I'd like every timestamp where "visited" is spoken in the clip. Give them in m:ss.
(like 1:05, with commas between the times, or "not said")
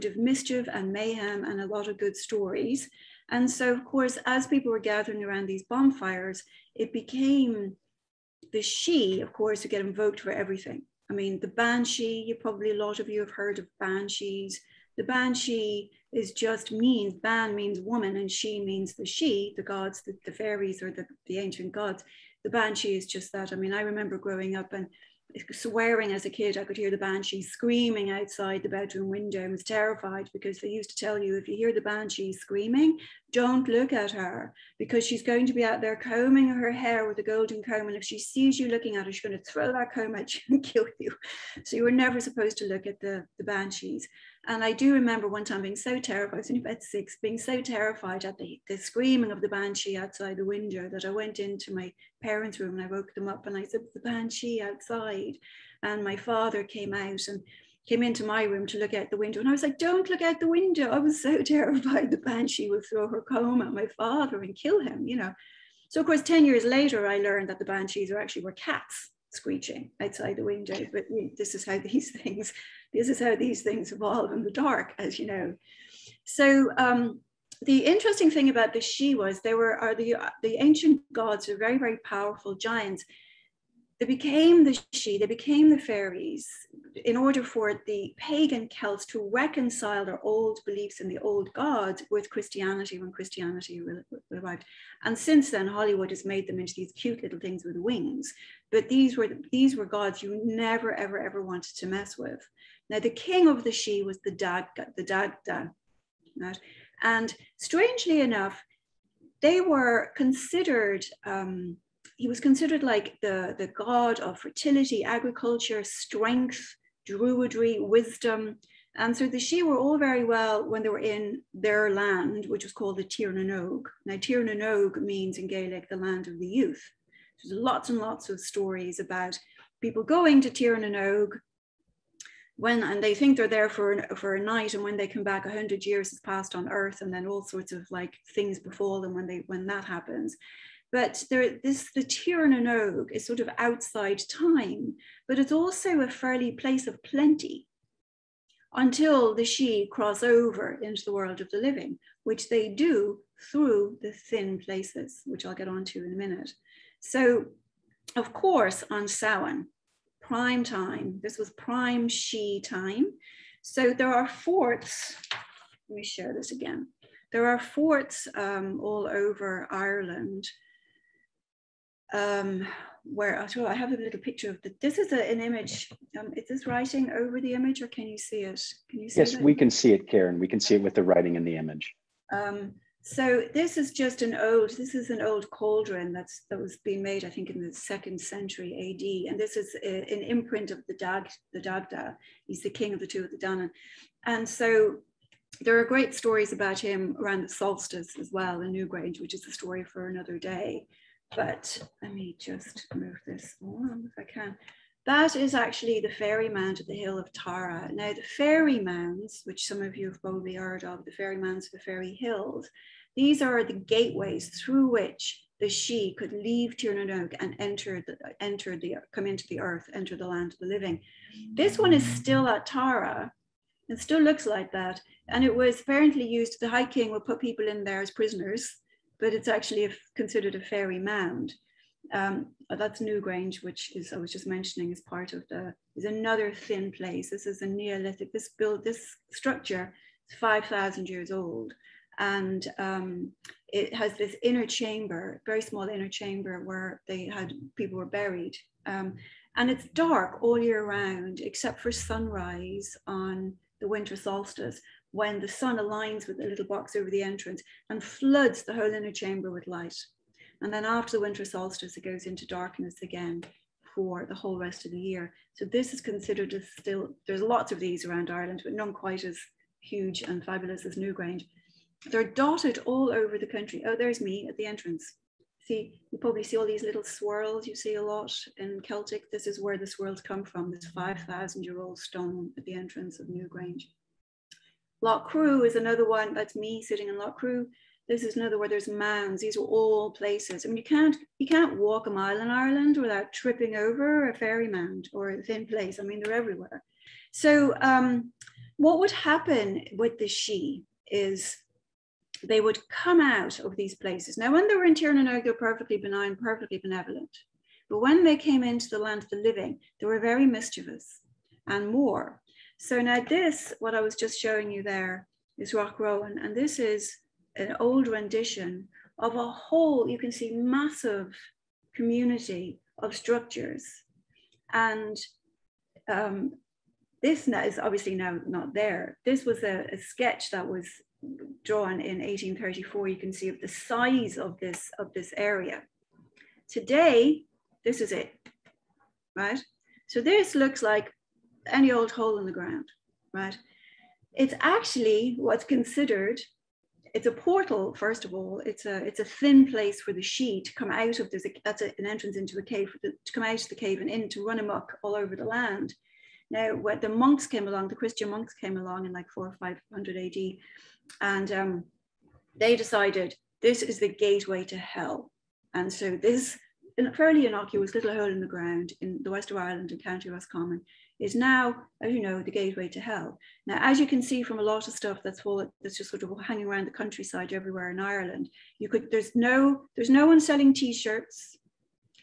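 not said.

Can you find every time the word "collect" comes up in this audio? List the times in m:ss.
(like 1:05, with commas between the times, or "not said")
not said.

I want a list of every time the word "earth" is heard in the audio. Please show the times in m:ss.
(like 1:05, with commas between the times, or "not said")
2:16, 3:39.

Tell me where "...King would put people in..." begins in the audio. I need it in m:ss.
3:46.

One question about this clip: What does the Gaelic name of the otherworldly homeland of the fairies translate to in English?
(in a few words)
the land of the youth.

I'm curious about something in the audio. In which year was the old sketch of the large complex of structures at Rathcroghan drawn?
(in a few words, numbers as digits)
1834.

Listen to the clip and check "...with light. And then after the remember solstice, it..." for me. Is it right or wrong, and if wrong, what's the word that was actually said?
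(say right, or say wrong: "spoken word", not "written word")
wrong: "winter", not "remember".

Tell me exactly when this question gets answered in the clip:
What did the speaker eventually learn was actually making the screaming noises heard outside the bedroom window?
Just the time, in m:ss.
1:08.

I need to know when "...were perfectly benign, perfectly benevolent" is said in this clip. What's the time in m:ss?
5:05.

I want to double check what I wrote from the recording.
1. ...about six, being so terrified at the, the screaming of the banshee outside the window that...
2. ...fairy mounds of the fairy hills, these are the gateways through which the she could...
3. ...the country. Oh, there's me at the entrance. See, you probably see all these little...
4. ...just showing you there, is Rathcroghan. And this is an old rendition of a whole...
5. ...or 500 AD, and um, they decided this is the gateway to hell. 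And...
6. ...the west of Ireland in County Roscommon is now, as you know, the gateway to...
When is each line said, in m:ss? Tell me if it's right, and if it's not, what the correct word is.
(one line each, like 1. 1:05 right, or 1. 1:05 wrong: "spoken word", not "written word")
1. 0:46 right
2. 3:31 right
3. 4:33 right
4. 5:14 right
5. 5:59 right
6. 6:09 right.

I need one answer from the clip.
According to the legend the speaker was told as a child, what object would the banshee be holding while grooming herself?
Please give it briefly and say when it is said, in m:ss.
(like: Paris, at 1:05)
golden comb, at 0:37.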